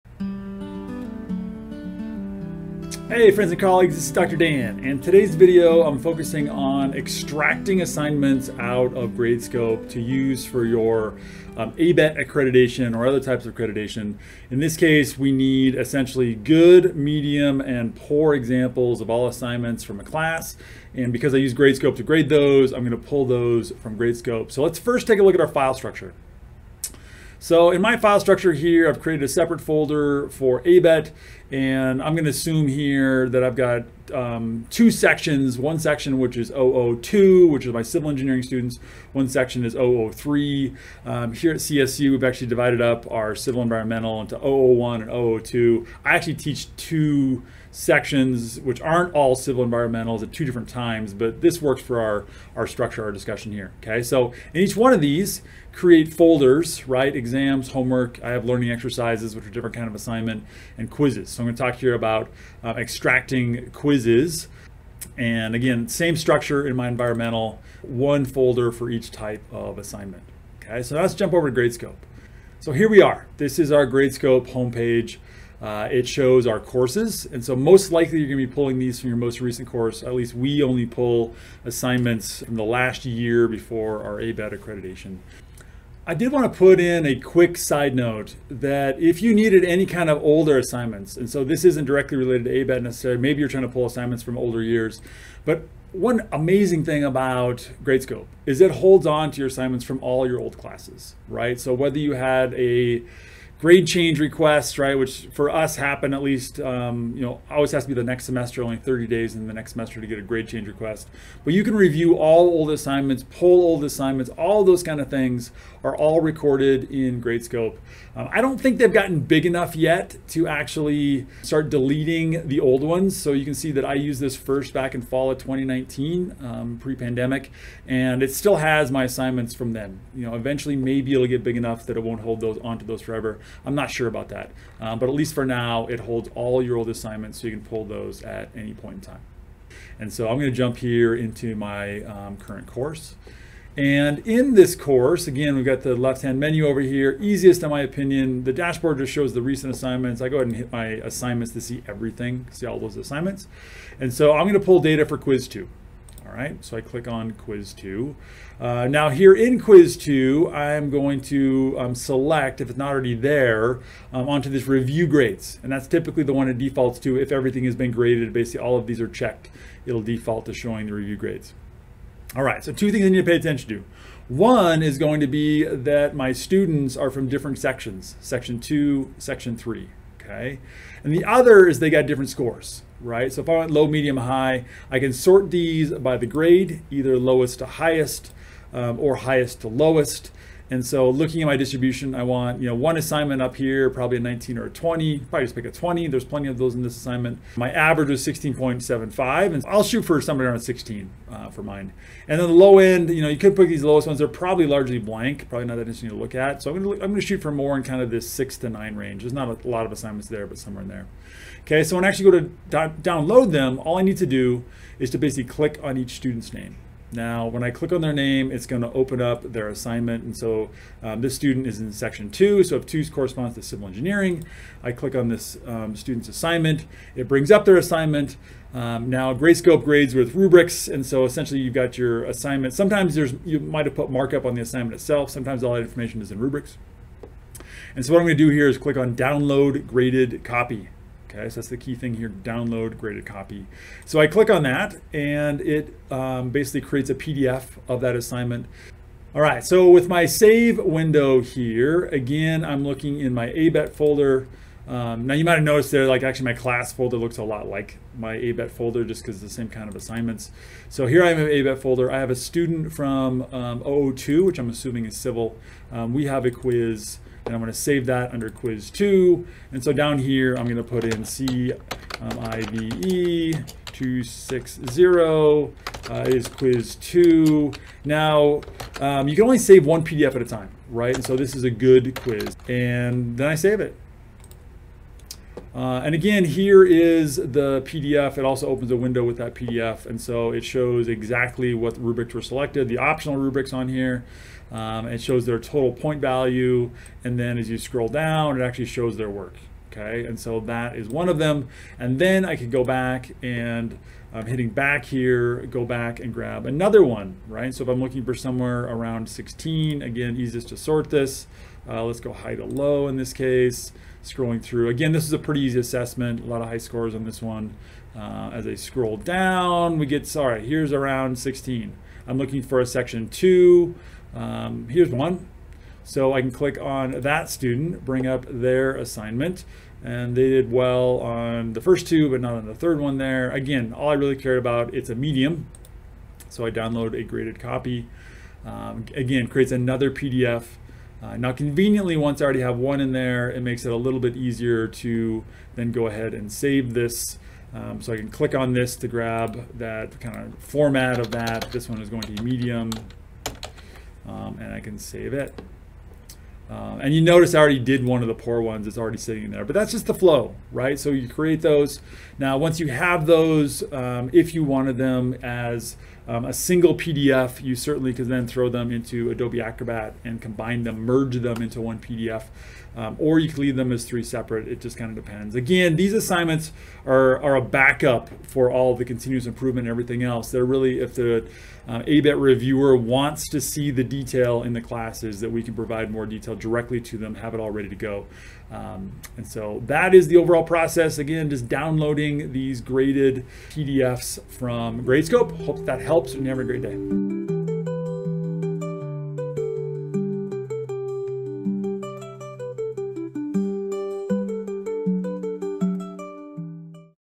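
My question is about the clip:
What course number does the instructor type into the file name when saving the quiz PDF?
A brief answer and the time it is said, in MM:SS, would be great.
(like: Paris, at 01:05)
260, at 04:33.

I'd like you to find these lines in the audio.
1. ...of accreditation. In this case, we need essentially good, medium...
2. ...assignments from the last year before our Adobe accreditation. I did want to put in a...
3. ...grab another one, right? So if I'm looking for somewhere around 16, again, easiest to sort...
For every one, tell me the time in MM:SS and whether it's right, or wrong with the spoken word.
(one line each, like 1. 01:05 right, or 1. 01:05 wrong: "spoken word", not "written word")
1. 00:13 right
2. 01:21 wrong: "ABET", not "Adobe"
3. 05:06 right.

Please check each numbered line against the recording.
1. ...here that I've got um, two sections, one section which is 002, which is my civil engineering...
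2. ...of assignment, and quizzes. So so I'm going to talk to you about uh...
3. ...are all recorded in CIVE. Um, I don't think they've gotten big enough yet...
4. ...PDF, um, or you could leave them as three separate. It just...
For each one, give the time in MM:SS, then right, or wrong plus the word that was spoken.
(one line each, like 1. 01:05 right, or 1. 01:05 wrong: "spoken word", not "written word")
1. 00:32 right
2. 00:59 right
3. 01:55 wrong: "Gradescope", not "CIVE"
4. 06:11 right.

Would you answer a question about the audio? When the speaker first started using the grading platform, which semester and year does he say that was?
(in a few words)
fall of 2019.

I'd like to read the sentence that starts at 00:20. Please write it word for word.
And because I use Gradescope to grade those, I'm gonna pull those from Gradescope.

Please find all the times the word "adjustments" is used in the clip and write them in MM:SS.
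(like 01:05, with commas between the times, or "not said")
not said.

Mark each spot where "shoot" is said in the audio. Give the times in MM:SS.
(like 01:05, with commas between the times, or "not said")
03:19, 03:27.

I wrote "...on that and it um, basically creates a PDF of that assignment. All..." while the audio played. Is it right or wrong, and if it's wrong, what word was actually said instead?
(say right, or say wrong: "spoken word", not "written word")
right.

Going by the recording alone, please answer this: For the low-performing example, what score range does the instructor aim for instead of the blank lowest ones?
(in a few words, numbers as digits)
6 to 9.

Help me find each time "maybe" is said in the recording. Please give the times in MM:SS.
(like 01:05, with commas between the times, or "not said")
01:33, 02:10.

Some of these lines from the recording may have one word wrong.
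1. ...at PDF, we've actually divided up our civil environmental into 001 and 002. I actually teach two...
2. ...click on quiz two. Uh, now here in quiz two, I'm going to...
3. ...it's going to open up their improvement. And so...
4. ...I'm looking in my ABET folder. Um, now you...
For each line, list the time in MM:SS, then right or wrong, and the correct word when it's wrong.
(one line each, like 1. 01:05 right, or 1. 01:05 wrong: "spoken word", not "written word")
1. 00:41 wrong: "CSU", not "PDF"
2. 02:36 right
3. 03:38 wrong: "assignment", not "improvement"
4. 04:12 right.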